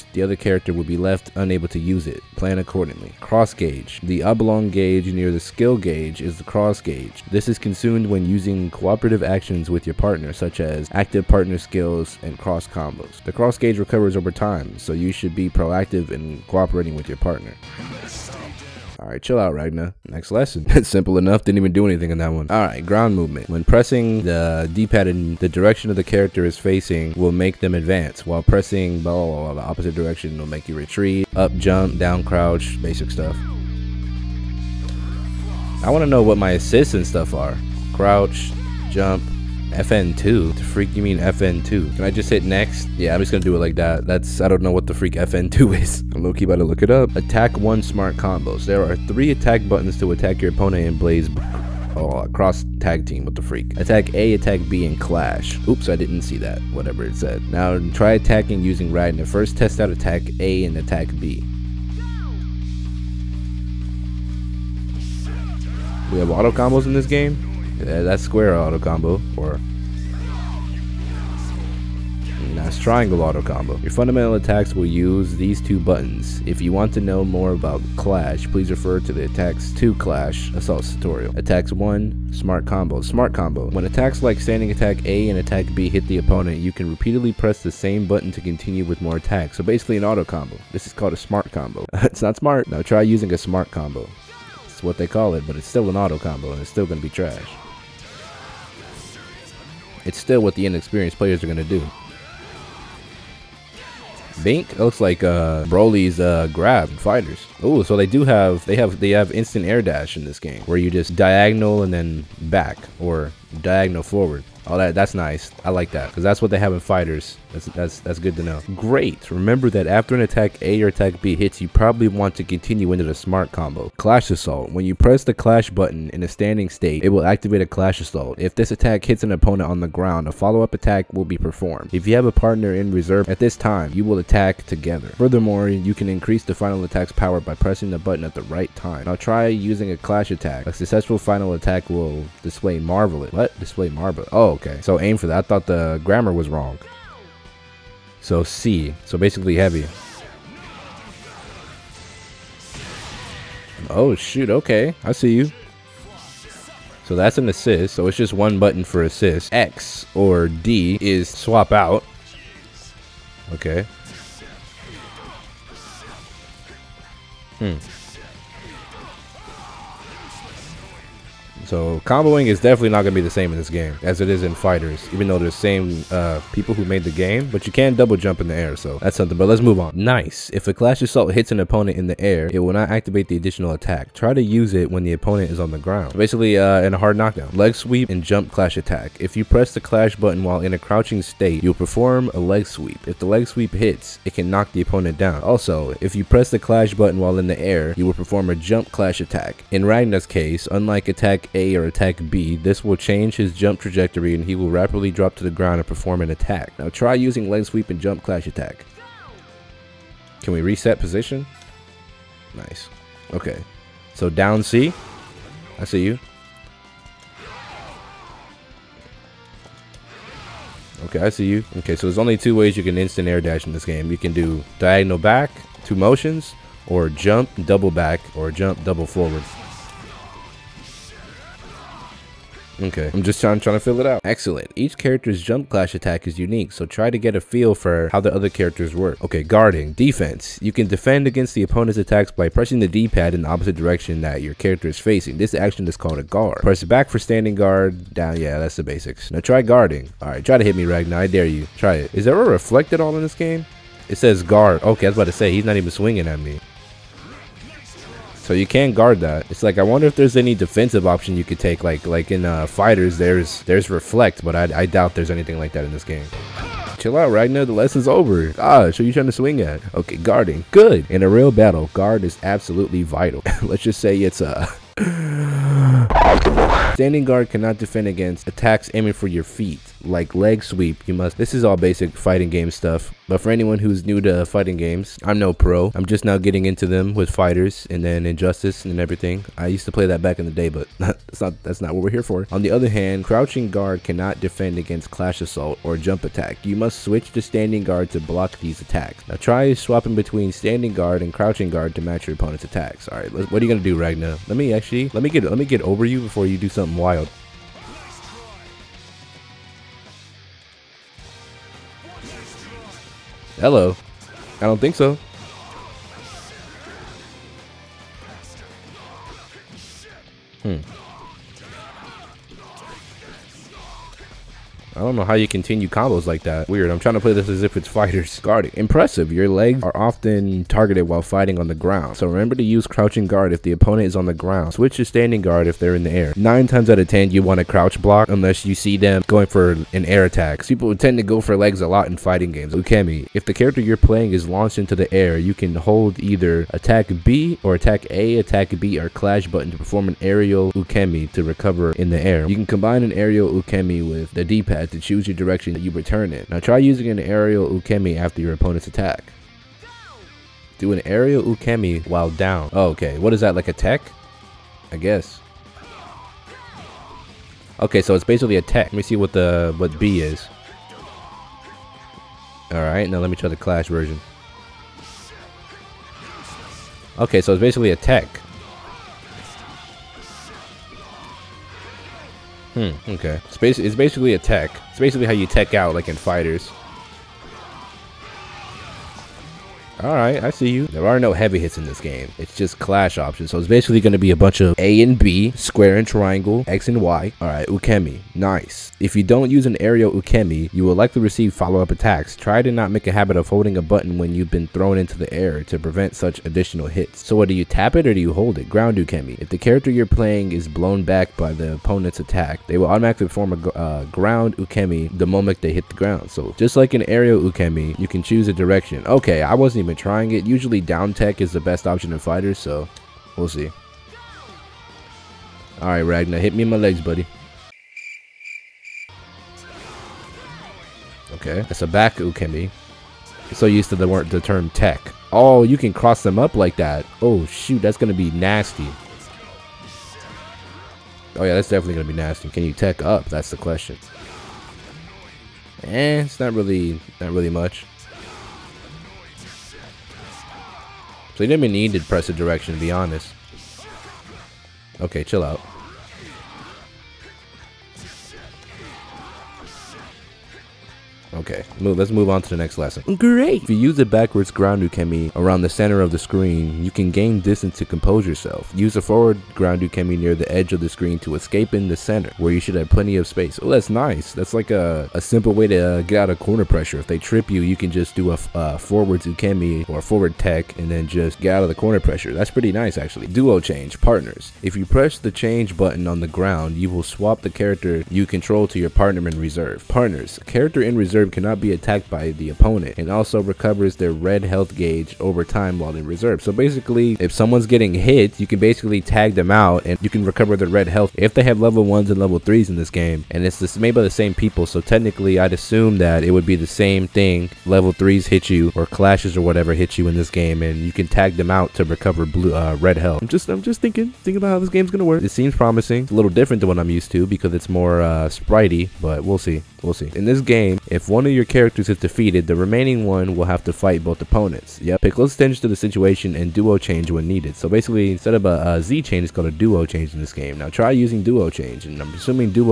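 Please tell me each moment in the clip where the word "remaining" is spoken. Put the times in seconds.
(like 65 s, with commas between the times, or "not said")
522 s.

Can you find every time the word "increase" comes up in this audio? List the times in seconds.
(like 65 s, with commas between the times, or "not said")
136 s.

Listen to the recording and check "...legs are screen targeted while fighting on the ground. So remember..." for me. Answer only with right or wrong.
wrong.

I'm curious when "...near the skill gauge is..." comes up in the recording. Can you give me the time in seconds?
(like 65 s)
5 s.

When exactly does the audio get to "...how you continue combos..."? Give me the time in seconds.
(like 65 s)
325 s.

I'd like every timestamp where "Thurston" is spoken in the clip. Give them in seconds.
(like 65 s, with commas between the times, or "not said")
not said.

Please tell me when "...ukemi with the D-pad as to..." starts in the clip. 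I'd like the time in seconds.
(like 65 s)
353 s.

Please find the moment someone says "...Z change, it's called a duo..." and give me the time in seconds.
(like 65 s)
528 s.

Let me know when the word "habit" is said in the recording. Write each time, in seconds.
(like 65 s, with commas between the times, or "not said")
403 s.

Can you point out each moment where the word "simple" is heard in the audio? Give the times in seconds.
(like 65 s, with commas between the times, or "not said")
20 s, 475 s.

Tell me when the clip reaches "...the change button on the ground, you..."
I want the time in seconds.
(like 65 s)
485 s.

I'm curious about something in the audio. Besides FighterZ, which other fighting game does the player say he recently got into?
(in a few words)
Injustice.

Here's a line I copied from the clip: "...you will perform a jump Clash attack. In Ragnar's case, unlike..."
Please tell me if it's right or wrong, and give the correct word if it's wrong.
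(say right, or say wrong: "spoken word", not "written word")
right.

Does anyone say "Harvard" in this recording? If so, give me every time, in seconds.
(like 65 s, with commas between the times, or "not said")
not said.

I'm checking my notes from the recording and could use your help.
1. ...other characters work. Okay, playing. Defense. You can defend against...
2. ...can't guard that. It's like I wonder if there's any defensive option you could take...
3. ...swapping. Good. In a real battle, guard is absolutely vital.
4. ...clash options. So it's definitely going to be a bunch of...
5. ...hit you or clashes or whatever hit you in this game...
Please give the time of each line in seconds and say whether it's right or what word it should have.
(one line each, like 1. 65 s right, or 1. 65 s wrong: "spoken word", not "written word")
1. 238 s wrong: "guarding", not "playing"
2. 258 s right
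3. 270 s wrong: "guarding", not "swapping"
4. 392 s wrong: "basically", not "definitely"
5. 508 s right.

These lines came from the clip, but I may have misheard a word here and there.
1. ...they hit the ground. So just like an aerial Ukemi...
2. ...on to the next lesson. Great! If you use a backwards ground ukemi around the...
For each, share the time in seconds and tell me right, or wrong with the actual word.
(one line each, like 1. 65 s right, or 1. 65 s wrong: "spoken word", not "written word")
1. 415 s right
2. 462 s right.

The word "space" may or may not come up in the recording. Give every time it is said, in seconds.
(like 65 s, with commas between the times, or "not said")
473 s.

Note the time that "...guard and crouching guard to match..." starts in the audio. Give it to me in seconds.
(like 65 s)
300 s.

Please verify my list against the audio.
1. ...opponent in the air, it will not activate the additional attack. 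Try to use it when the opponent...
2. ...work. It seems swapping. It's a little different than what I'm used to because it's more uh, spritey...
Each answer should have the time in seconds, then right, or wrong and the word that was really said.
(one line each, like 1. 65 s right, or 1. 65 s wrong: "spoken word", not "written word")
1. 181 s right
2. 515 s wrong: "promising", not "swapping".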